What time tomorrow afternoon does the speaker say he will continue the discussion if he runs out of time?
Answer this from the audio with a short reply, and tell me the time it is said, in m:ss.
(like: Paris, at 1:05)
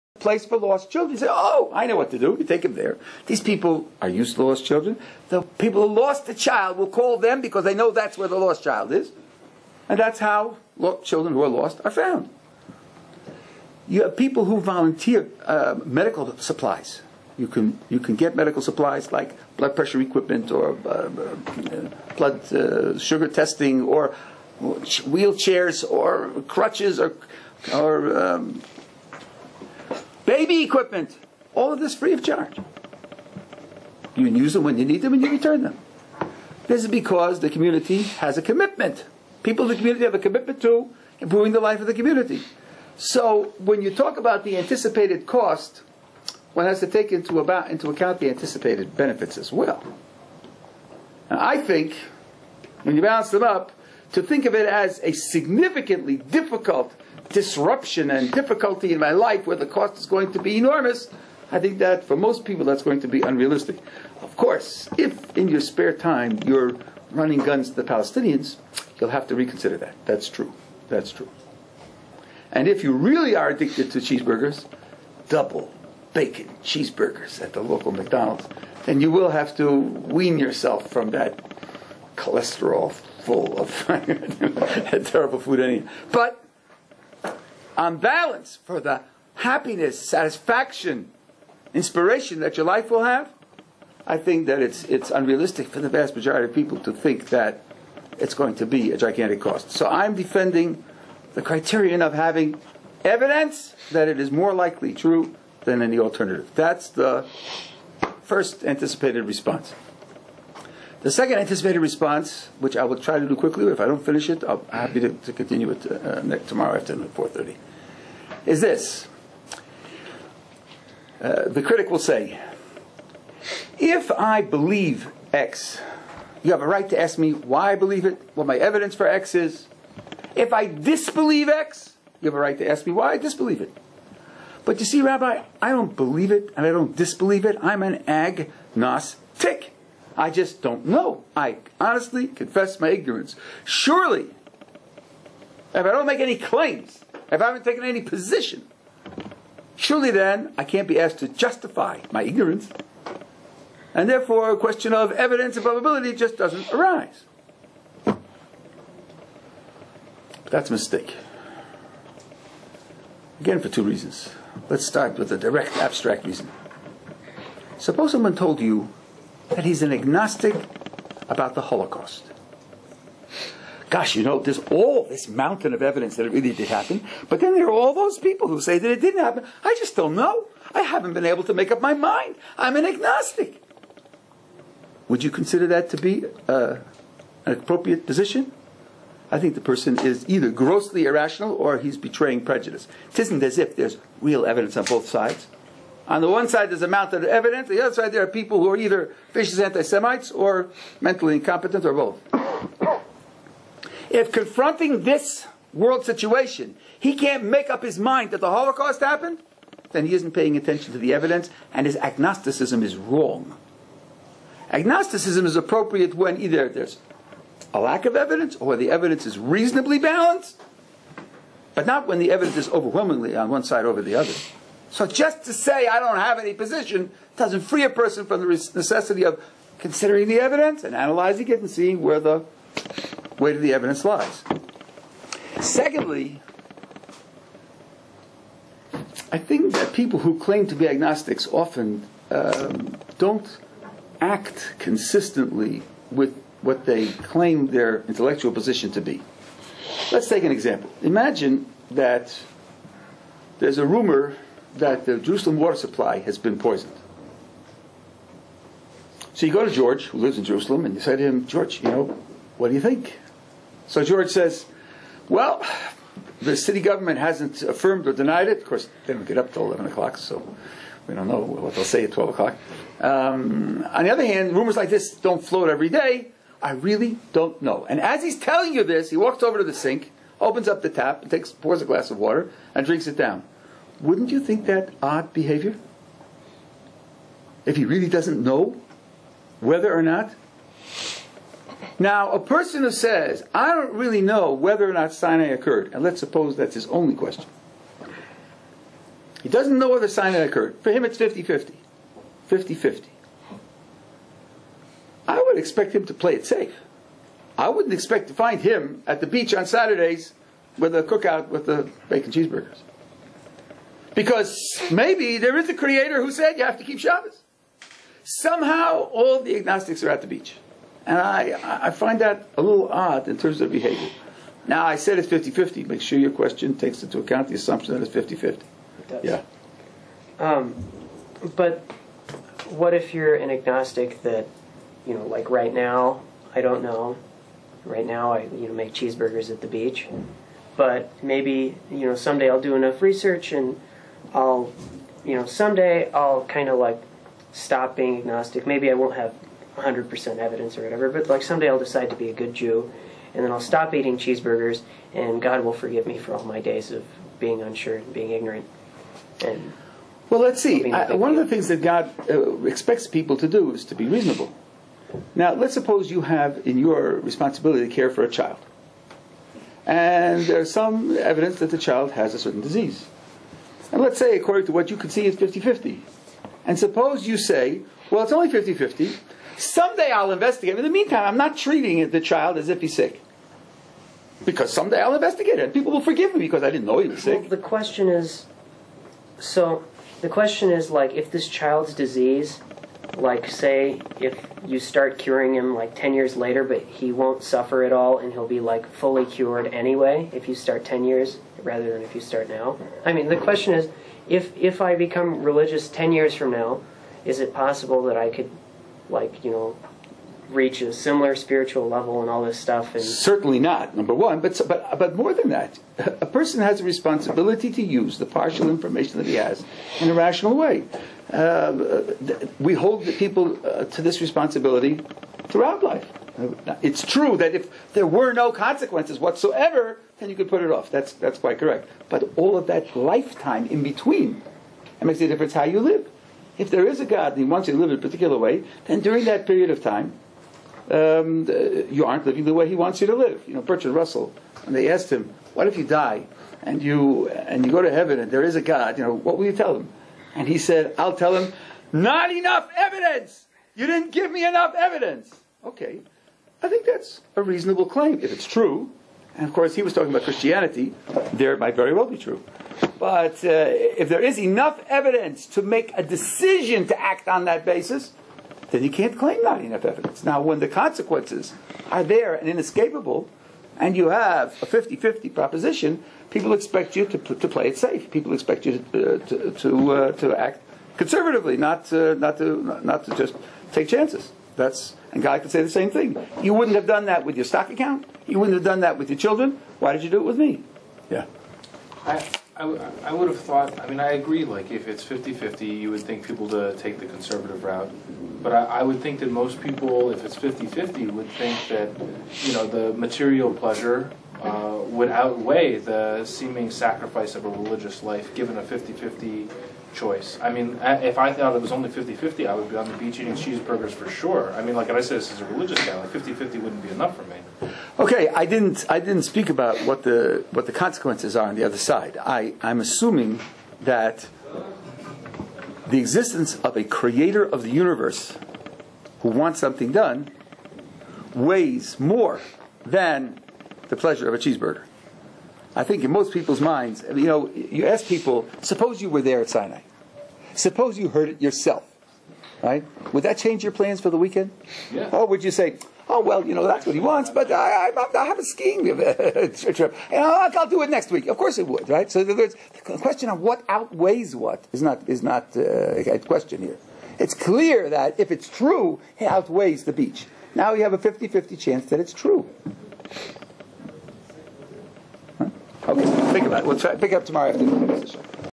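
4:30, at 1:57.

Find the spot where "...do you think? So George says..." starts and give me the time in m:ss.
4:22.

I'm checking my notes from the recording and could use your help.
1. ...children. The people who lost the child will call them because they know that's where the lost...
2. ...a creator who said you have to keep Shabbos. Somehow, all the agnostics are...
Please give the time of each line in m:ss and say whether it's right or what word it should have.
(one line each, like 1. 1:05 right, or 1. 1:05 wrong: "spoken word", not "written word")
1. 0:04 right
2. 5:15 right.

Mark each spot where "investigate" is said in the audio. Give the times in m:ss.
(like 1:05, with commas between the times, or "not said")
6:20, 6:25.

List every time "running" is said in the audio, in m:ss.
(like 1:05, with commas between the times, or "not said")
1:07.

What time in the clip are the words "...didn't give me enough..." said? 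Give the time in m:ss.
7:33.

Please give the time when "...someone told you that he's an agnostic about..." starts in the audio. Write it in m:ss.
2:48.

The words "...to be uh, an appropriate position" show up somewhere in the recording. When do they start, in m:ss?
3:05.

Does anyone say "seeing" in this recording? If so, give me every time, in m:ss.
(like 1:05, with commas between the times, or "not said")
3:51.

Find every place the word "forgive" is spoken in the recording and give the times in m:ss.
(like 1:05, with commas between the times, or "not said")
5:55, 6:26.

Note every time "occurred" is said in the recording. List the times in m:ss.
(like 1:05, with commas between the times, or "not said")
4:55, 5:00.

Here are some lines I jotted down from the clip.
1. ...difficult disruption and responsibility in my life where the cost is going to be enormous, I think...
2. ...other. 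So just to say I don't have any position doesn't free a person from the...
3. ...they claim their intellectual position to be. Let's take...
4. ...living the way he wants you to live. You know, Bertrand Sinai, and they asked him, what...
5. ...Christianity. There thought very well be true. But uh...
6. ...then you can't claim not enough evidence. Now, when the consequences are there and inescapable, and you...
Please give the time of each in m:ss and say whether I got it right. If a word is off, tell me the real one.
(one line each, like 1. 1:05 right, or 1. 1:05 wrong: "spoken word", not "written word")
1. 0:56 wrong: "difficulty", not "responsibility"
2. 3:44 right
3. 4:06 right
4. 7:22 wrong: "Russell", not "Sinai"
5. 7:40 wrong: "might", not "thought"
6. 7:48 right.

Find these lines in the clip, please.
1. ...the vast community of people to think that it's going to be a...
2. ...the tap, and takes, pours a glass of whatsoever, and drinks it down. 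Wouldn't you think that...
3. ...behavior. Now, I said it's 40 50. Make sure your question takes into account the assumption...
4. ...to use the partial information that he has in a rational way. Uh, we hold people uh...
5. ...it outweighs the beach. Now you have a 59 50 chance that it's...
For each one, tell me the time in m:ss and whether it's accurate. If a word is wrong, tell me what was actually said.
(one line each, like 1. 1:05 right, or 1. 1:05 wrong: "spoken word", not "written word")
1. 1:35 wrong: "majority", not "community"
2. 4:40 wrong: "water", not "whatsoever"
3. 5:23 wrong: "50", not "40"
4. 6:57 right
5. 9:19 wrong: "50", not "59".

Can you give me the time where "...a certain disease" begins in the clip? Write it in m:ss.
6:12.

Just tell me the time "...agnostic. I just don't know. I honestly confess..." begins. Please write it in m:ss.
2:18.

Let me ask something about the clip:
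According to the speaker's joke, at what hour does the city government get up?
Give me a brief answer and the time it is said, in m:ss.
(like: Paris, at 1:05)
11 o'clock, at 4:29.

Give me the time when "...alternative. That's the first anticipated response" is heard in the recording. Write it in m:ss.
1:45.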